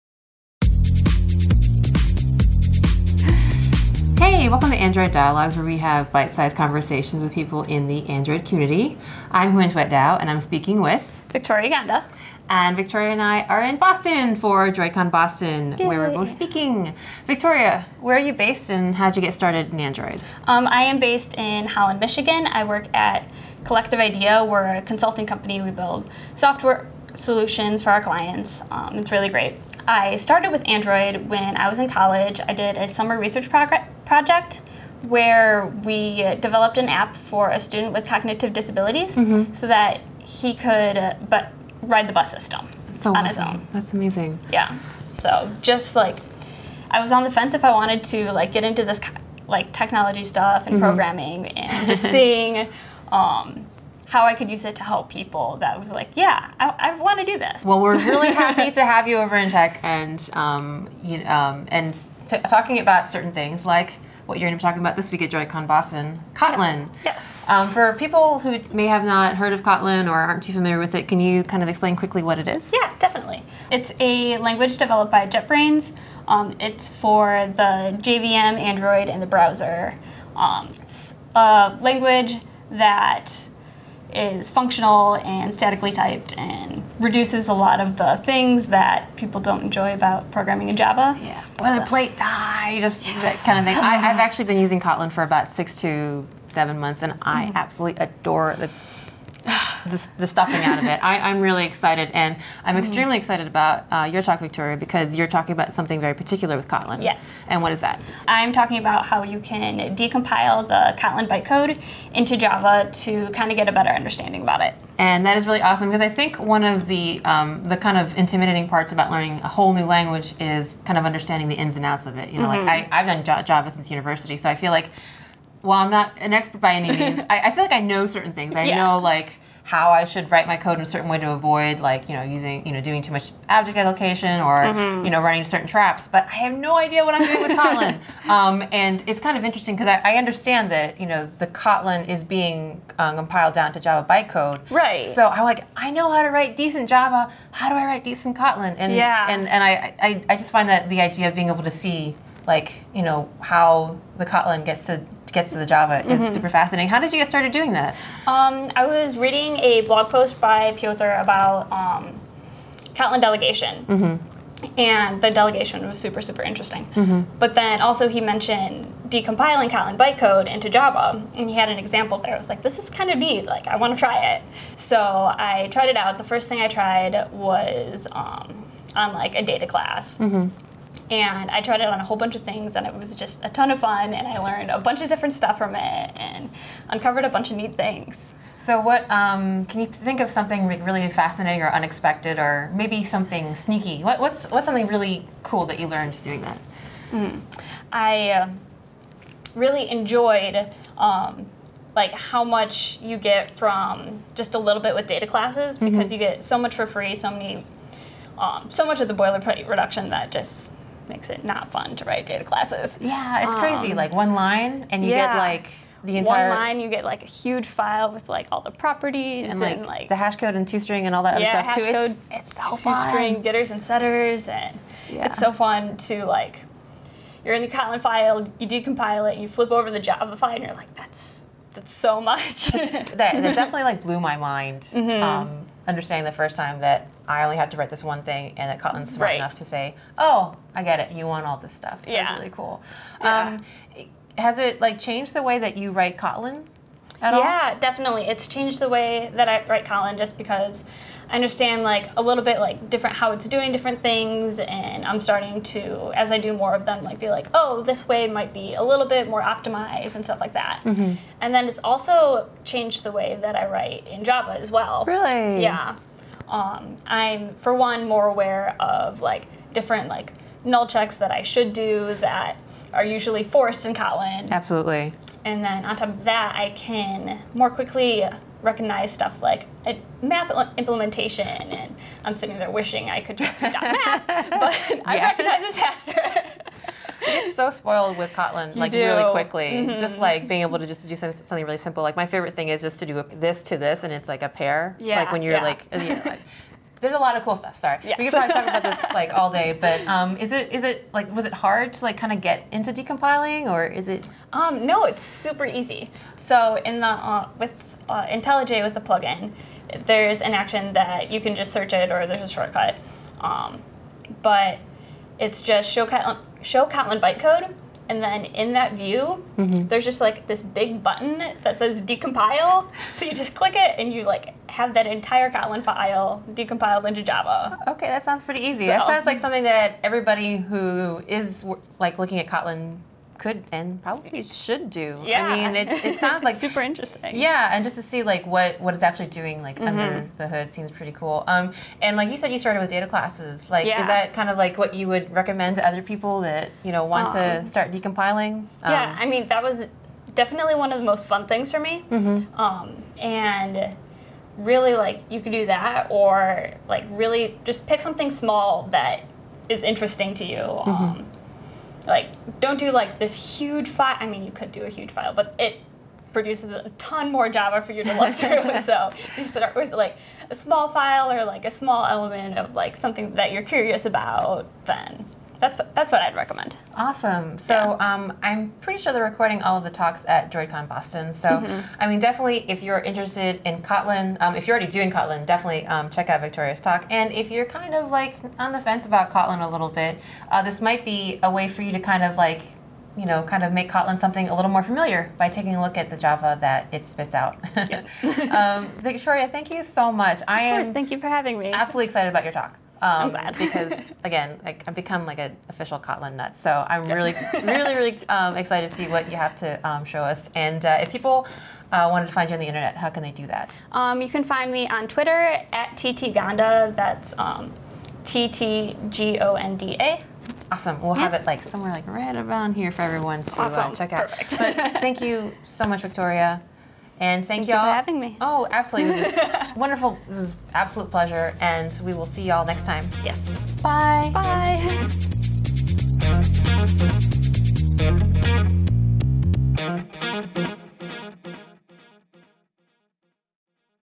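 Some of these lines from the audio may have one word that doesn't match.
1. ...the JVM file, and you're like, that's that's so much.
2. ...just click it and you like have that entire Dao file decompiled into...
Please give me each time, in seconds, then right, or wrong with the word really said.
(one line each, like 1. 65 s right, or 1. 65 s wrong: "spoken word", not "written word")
1. 229 s wrong: "Java", not "JVM"
2. 323 s wrong: "Kotlin", not "Dao".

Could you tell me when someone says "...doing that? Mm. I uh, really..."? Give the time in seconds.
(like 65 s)
196 s.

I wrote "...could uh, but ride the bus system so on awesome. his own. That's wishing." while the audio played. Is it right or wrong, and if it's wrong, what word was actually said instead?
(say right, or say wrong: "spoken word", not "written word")
wrong: "amazing", not "wishing".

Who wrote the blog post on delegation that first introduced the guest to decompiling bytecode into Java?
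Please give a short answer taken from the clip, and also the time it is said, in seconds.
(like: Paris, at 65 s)
Piotr, at 160 s.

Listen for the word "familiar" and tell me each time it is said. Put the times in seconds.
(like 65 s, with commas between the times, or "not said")
70 s, 394 s.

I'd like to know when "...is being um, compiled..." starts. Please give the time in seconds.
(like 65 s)
142 s.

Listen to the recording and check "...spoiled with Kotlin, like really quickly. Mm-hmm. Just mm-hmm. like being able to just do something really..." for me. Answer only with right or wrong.
right.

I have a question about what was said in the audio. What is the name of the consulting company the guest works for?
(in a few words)
Collective Idea.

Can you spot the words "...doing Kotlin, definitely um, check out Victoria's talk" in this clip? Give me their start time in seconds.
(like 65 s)
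384 s.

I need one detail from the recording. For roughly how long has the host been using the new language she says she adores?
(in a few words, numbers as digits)
6 to 7 months.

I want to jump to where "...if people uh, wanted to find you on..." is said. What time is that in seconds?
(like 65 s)
411 s.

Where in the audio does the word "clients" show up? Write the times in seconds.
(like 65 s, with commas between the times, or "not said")
28 s.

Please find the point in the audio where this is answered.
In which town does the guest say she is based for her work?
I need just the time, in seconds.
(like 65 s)
21 s.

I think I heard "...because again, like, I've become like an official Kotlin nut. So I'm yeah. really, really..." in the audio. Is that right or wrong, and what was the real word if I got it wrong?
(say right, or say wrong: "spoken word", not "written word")
right.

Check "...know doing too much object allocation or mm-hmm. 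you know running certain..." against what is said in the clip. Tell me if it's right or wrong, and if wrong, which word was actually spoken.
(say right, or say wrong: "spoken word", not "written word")
right.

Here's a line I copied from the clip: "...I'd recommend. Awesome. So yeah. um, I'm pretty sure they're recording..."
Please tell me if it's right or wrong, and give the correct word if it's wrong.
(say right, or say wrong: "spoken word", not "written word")
right.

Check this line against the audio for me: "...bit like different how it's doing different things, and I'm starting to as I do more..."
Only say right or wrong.
right.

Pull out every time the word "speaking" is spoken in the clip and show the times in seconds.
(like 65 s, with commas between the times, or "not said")
10 s, 16 s.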